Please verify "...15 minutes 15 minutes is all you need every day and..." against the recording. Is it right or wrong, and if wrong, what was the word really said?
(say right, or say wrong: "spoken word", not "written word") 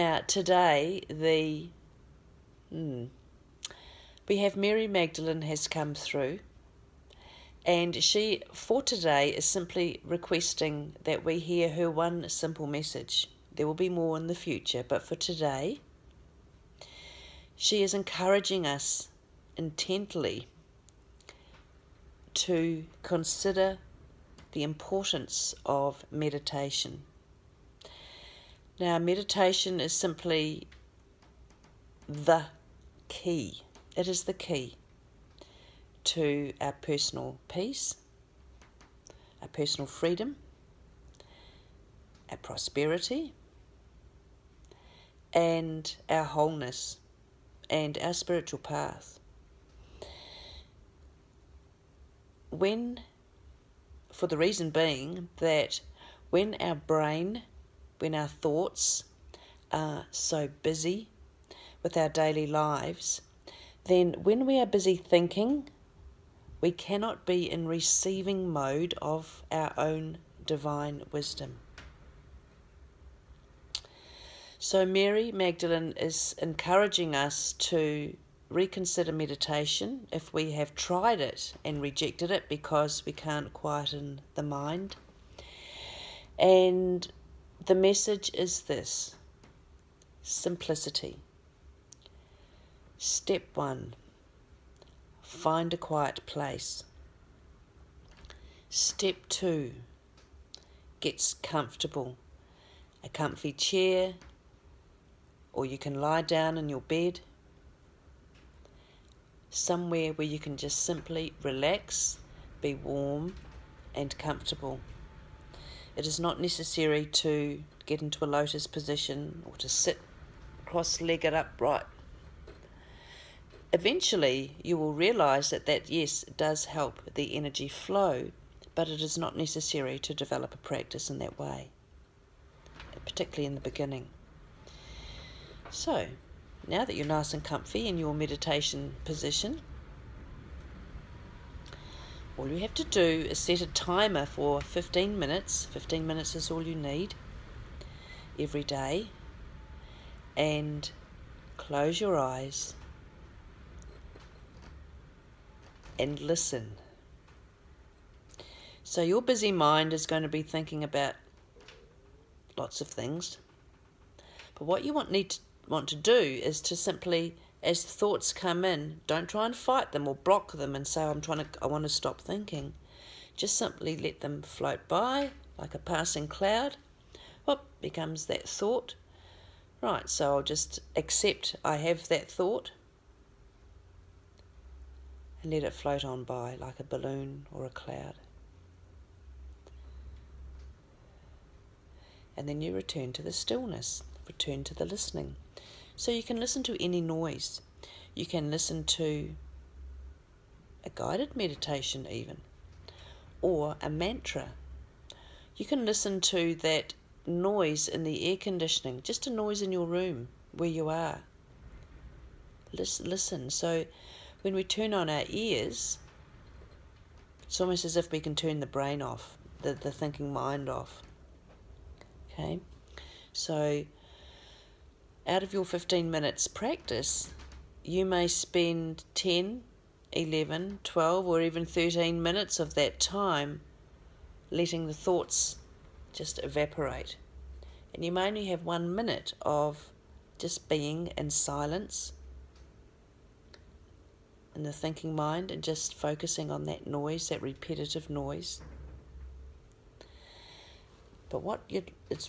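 right.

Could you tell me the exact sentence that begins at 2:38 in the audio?
So, your busy mind is going to be thinking about lots of things.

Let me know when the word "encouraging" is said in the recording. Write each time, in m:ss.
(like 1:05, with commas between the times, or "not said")
0:17, 1:16.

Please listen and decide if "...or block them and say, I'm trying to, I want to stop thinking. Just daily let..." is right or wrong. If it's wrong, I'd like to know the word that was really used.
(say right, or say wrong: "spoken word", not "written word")
wrong: "simply", not "daily".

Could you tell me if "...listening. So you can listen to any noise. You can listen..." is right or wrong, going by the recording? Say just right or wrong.
right.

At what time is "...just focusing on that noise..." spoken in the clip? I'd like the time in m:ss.
4:05.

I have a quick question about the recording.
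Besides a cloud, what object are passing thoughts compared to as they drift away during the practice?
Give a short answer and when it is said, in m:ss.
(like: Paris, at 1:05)
a balloon, at 3:06.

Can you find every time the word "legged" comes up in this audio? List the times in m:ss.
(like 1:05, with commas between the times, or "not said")
2:01.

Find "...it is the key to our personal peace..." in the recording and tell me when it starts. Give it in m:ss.
0:33.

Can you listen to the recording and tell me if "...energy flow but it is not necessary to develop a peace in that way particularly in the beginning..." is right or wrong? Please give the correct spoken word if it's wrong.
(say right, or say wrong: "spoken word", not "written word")
wrong: "practice", not "peace".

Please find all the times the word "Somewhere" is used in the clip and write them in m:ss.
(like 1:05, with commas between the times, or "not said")
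1:49.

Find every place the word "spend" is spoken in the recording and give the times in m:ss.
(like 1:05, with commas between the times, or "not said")
3:48.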